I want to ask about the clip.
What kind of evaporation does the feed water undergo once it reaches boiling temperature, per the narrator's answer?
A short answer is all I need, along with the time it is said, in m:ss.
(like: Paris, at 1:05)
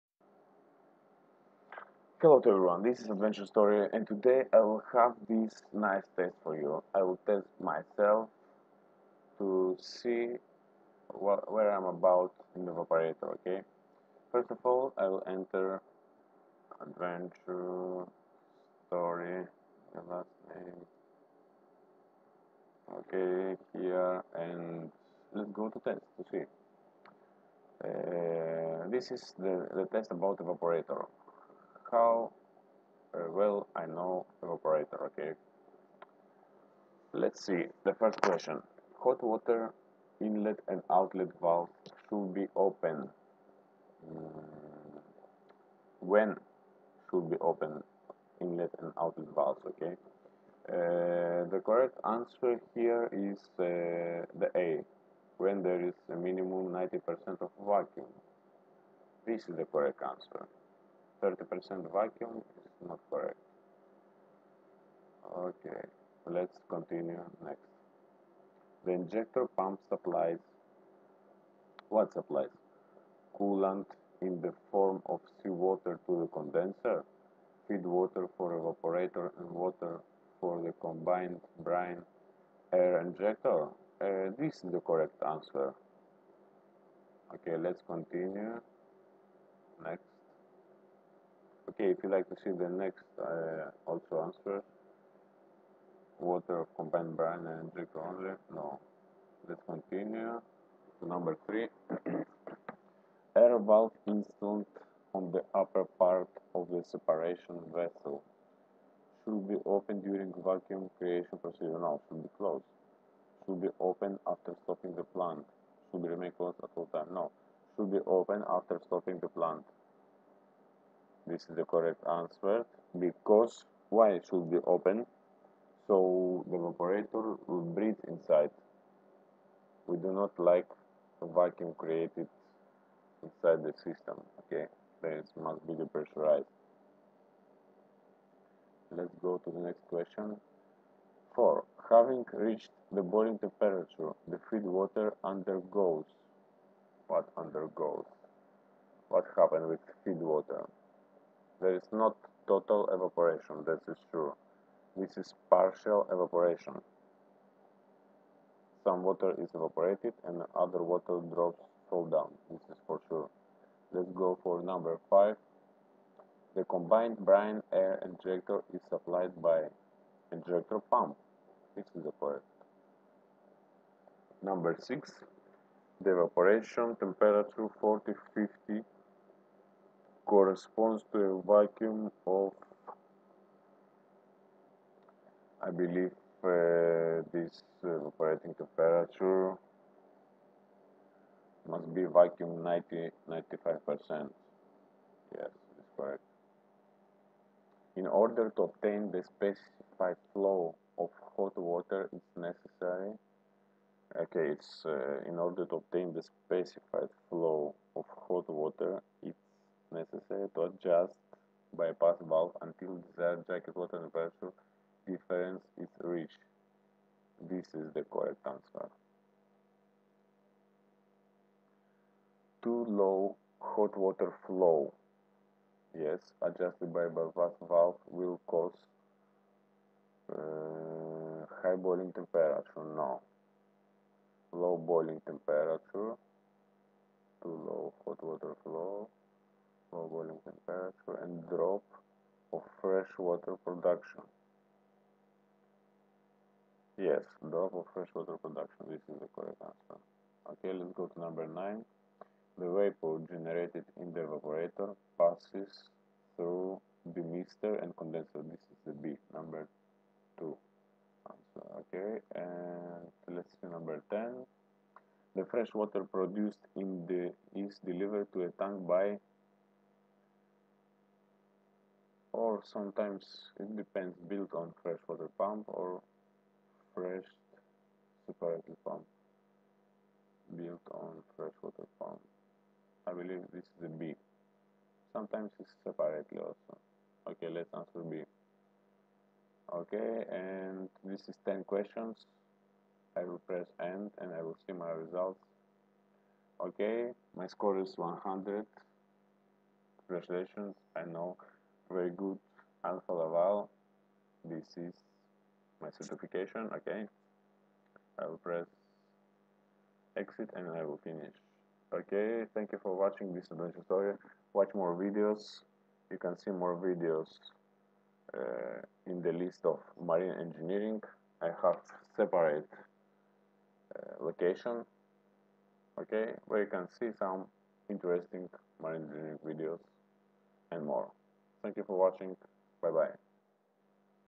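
Partial evaporation, at 2:35.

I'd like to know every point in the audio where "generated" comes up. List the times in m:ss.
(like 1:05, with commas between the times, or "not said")
4:13.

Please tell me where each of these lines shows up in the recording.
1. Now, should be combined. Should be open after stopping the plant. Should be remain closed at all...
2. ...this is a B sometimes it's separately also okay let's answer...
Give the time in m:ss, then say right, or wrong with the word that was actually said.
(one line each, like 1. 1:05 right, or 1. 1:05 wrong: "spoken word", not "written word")
1. 1:51 wrong: "closed", not "combined"
2. 4:43 right.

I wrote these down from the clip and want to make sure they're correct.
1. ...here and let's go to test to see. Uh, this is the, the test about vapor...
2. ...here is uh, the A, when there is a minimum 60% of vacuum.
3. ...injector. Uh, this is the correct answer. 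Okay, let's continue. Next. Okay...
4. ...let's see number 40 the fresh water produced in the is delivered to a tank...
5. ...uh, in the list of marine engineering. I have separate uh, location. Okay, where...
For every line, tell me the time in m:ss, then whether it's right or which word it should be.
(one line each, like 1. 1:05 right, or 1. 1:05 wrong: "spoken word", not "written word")
1. 0:23 wrong: "evaporator", not "vapor"
2. 0:52 wrong: "90", not "60"
3. 1:23 right
4. 4:23 wrong: "10", not "40"
5. 5:18 right.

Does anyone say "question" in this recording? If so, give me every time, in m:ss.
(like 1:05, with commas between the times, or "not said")
0:38, 2:19, 4:51.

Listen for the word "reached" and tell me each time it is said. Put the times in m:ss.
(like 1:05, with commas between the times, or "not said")
2:22, 3:36.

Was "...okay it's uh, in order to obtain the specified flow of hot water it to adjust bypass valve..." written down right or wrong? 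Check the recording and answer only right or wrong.
right.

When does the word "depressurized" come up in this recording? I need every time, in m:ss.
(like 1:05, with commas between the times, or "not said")
2:15.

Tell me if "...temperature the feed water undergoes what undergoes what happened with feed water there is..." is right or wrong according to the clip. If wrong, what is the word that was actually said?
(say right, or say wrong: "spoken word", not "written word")
right.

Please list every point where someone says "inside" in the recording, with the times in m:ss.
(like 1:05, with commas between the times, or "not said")
2:08, 2:13.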